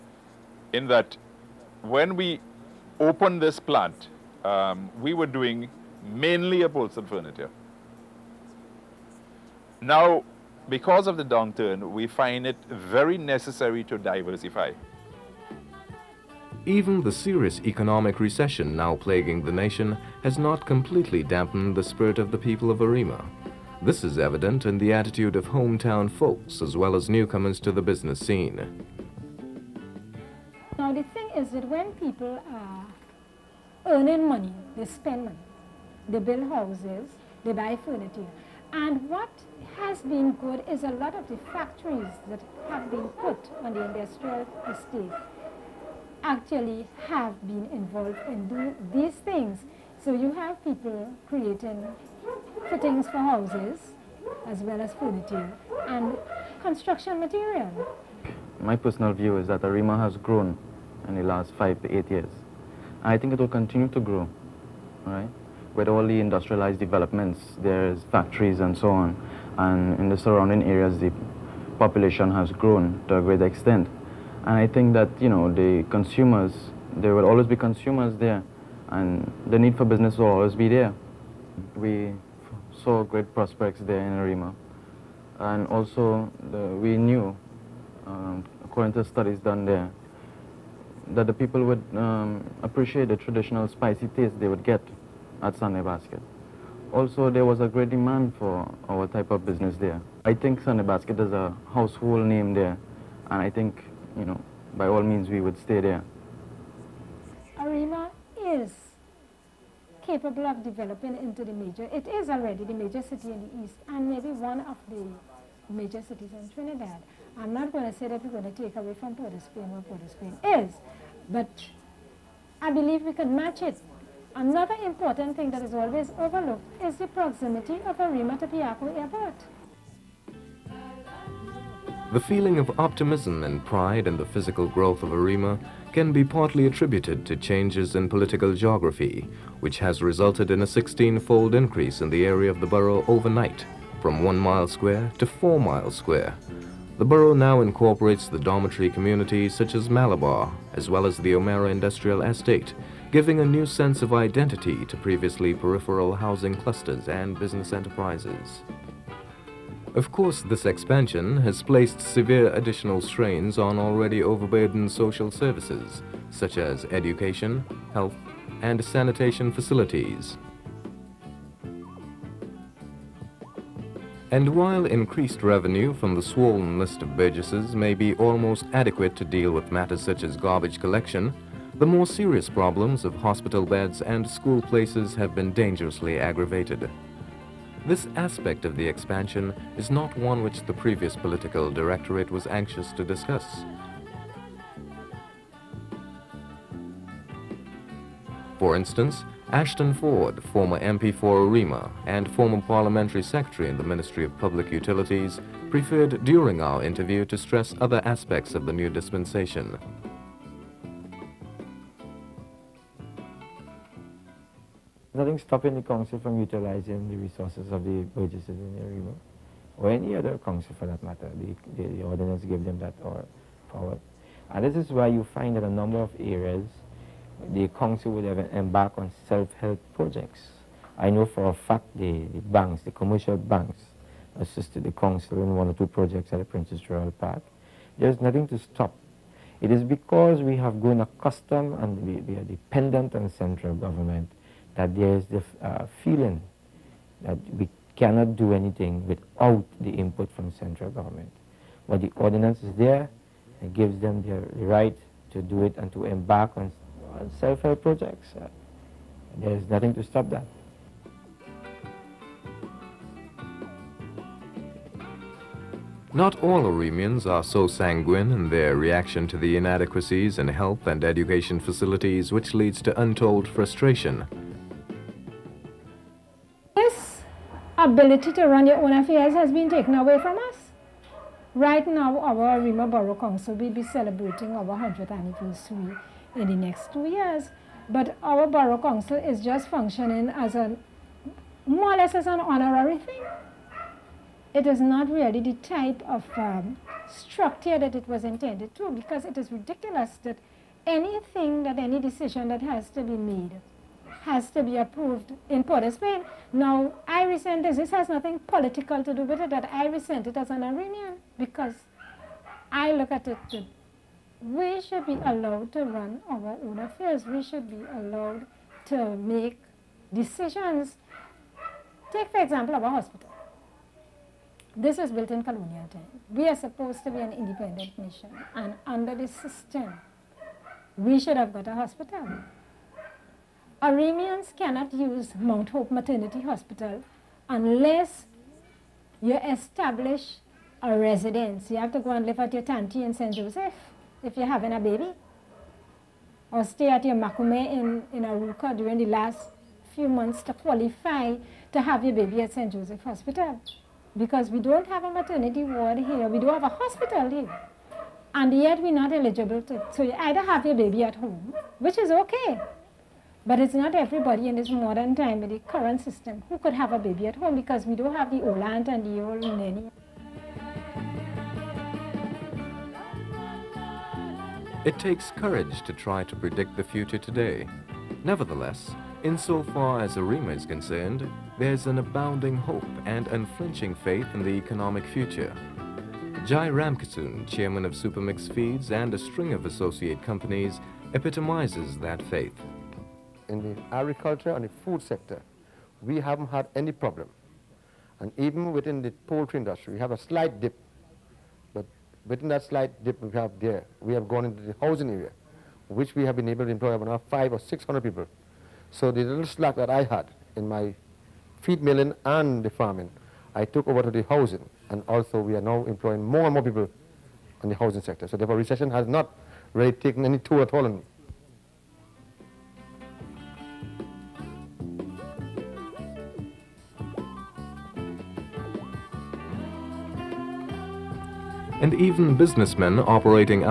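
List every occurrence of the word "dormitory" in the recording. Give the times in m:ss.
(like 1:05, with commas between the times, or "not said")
2:28.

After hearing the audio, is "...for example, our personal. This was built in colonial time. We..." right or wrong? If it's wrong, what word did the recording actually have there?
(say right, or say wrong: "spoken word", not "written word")
wrong: "hospital", not "personal".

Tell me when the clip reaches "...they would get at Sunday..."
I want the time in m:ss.
1:34.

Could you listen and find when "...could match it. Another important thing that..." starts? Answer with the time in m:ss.
2:03.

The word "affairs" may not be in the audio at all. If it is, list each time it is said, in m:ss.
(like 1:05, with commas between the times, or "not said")
4:38, 5:16.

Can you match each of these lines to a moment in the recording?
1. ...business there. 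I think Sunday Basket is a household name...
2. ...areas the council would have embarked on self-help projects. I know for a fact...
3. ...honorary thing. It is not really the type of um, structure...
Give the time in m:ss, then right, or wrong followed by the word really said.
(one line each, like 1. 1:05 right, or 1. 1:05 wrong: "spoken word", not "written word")
1. 1:39 right
2. 3:46 right
3. 4:52 right.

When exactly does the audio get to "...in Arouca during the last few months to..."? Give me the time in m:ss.
5:48.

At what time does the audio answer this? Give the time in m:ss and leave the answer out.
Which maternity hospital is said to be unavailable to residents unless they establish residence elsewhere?
5:35.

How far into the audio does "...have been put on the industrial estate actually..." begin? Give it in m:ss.
0:42.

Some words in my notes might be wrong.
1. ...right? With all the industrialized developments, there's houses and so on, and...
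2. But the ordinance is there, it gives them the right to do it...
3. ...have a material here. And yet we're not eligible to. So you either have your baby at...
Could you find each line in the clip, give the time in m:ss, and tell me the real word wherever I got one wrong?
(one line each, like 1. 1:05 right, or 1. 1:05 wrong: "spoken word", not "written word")
1. 1:05 wrong: "factories", not "houses"
2. 4:11 right
3. 5:56 wrong: "hospital", not "material".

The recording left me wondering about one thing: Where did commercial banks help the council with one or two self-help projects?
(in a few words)
Princess Royal Park.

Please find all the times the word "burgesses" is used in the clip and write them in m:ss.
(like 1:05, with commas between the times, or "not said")
2:57, 3:38.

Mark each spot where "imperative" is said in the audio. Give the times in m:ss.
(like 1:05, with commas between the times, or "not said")
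not said.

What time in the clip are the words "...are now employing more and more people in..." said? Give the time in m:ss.
6:55.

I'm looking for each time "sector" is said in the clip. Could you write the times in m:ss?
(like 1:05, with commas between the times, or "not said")
6:35, 6:58.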